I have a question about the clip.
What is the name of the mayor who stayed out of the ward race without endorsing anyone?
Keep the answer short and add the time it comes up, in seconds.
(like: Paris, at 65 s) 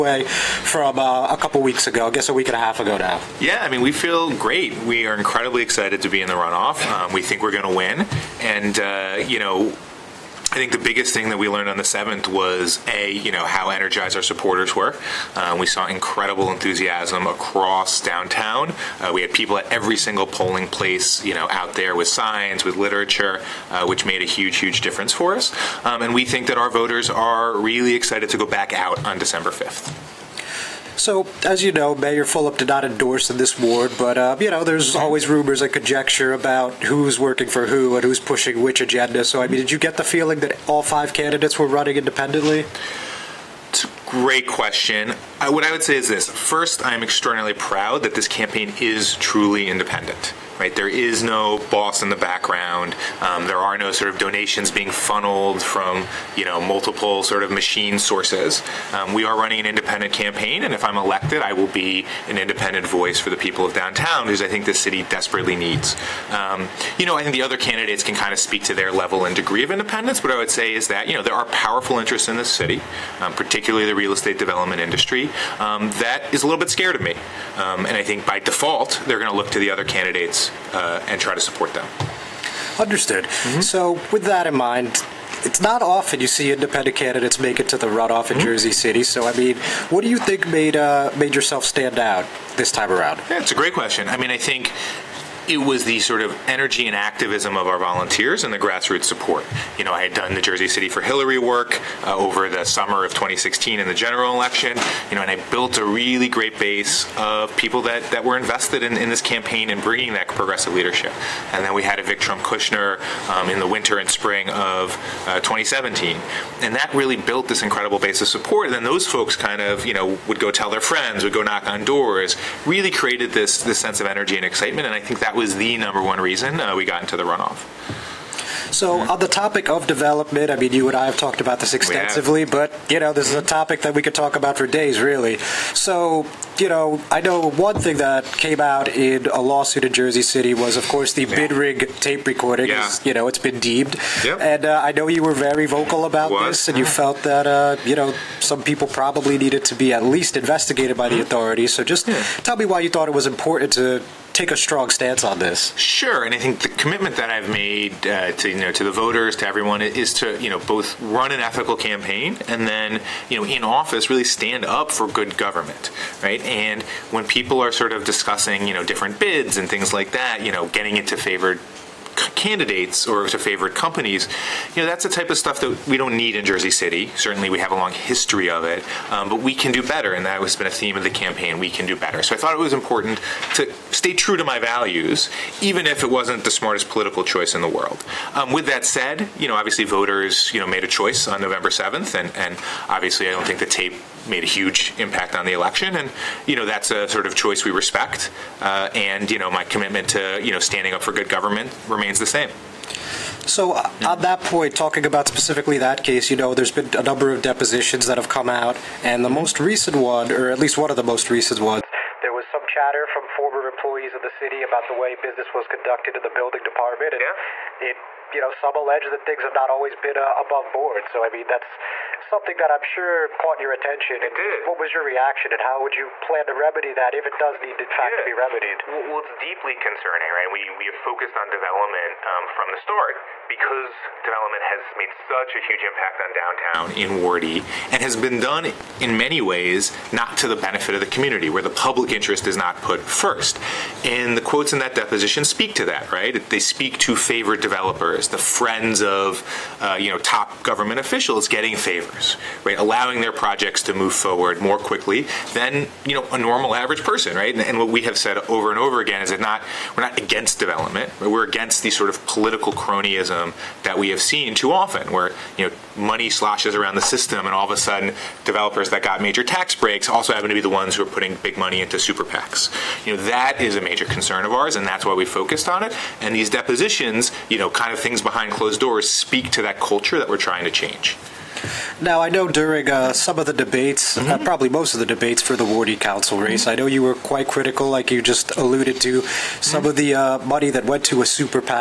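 Fulop, at 31 s.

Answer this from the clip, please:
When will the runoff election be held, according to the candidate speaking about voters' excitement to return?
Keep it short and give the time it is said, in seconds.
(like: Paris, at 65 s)
December 5, at 29 s.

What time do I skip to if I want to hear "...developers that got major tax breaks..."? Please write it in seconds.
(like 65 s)
268 s.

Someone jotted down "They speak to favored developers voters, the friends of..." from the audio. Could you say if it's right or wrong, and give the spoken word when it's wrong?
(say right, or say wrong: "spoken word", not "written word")
wrong: "favors", not "voters".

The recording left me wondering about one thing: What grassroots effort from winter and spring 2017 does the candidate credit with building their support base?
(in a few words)
Evict Trump Kushner.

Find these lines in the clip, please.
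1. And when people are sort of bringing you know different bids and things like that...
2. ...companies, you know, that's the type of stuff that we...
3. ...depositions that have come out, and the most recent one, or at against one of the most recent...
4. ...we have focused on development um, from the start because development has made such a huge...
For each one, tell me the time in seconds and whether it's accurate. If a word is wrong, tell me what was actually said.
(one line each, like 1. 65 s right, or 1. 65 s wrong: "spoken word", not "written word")
1. 166 s wrong: "discussing", not "bringing"
2. 173 s right
3. 207 s wrong: "least", not "against"
4. 230 s right.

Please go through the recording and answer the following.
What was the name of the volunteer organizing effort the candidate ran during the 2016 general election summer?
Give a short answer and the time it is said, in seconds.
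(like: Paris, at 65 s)
Jersey City for Hillary, at 100 s.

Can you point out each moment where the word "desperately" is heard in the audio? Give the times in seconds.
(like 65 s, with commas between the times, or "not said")
65 s.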